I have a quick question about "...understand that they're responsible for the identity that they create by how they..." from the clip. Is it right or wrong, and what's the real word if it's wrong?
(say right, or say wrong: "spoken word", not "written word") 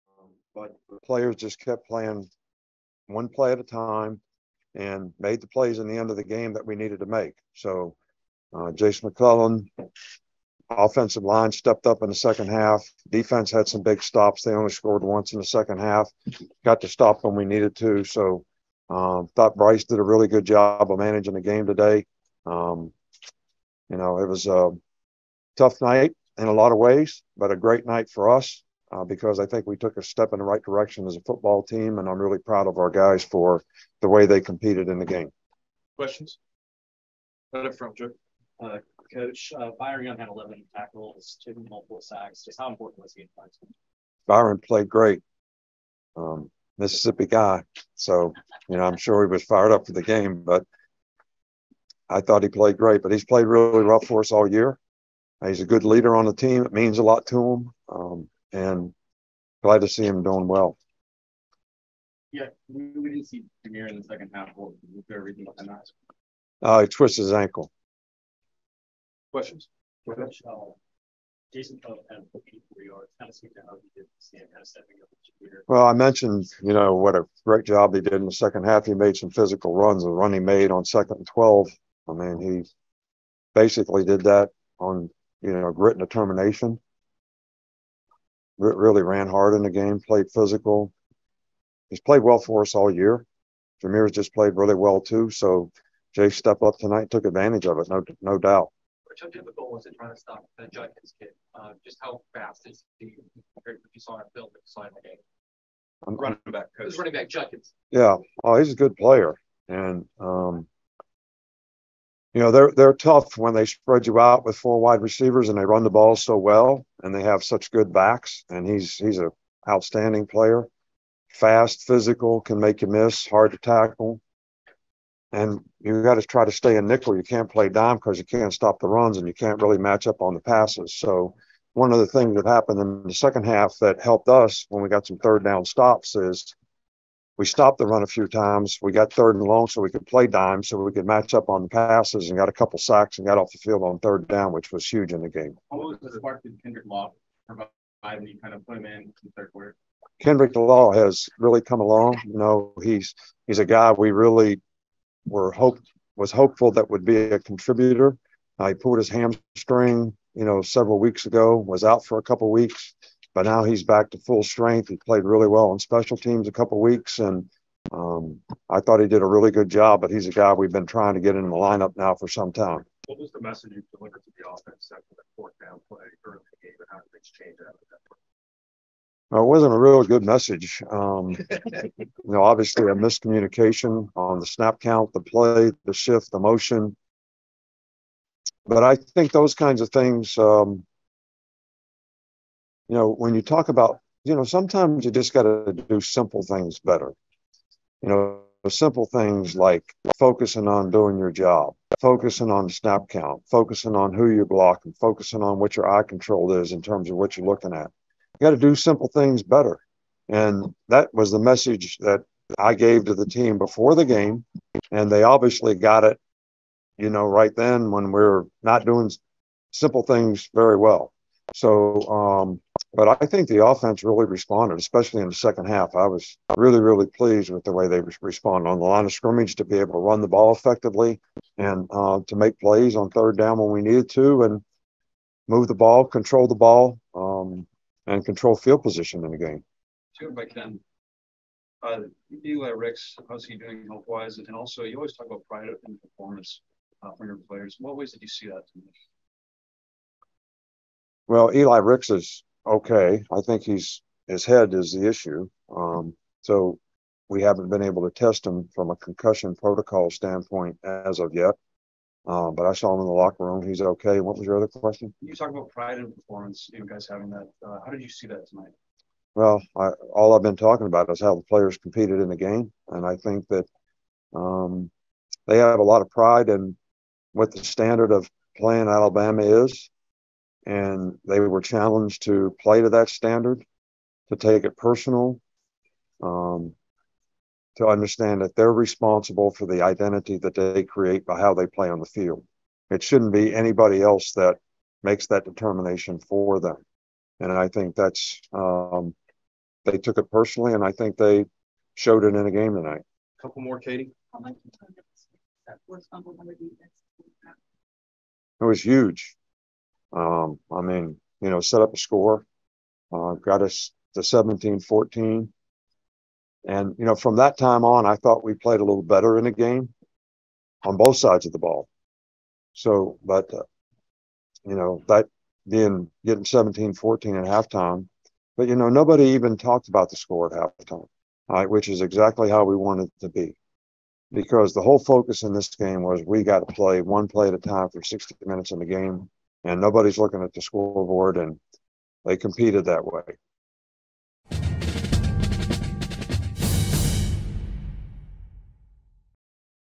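right.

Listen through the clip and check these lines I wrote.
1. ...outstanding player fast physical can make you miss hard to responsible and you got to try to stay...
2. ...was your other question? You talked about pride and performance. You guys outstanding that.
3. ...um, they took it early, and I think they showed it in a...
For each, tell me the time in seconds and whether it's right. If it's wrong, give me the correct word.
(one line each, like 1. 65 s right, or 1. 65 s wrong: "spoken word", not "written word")
1. 119 s wrong: "tackle", not "responsible"
2. 264 s wrong: "having", not "outstanding"
3. 298 s wrong: "personally", not "early".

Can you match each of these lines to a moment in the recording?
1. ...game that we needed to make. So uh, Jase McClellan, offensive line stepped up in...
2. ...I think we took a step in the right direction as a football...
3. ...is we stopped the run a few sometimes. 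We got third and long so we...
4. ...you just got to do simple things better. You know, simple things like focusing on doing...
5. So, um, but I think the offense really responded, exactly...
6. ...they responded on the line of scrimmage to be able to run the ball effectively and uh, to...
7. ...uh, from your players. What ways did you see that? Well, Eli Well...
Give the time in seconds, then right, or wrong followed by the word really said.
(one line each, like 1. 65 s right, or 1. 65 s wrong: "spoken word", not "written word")
1. 6 s right
2. 29 s right
3. 136 s wrong: "times", not "sometimes"
4. 195 s right
5. 221 s wrong: "especially", not "exactly"
6. 227 s right
7. 247 s wrong: "Ricks", not "Well".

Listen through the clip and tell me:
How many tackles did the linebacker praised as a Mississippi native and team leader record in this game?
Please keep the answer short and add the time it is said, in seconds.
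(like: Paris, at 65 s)
11, at 40 s.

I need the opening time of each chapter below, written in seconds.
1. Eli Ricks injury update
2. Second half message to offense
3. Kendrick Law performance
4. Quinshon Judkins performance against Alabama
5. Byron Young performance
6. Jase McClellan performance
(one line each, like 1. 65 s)
1. 250 s
2. 178 s
3. 149 s
4. 111 s
5. 43 s
6. 75 s.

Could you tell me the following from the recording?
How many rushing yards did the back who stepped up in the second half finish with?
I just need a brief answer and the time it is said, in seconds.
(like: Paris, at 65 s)
84, at 72 s.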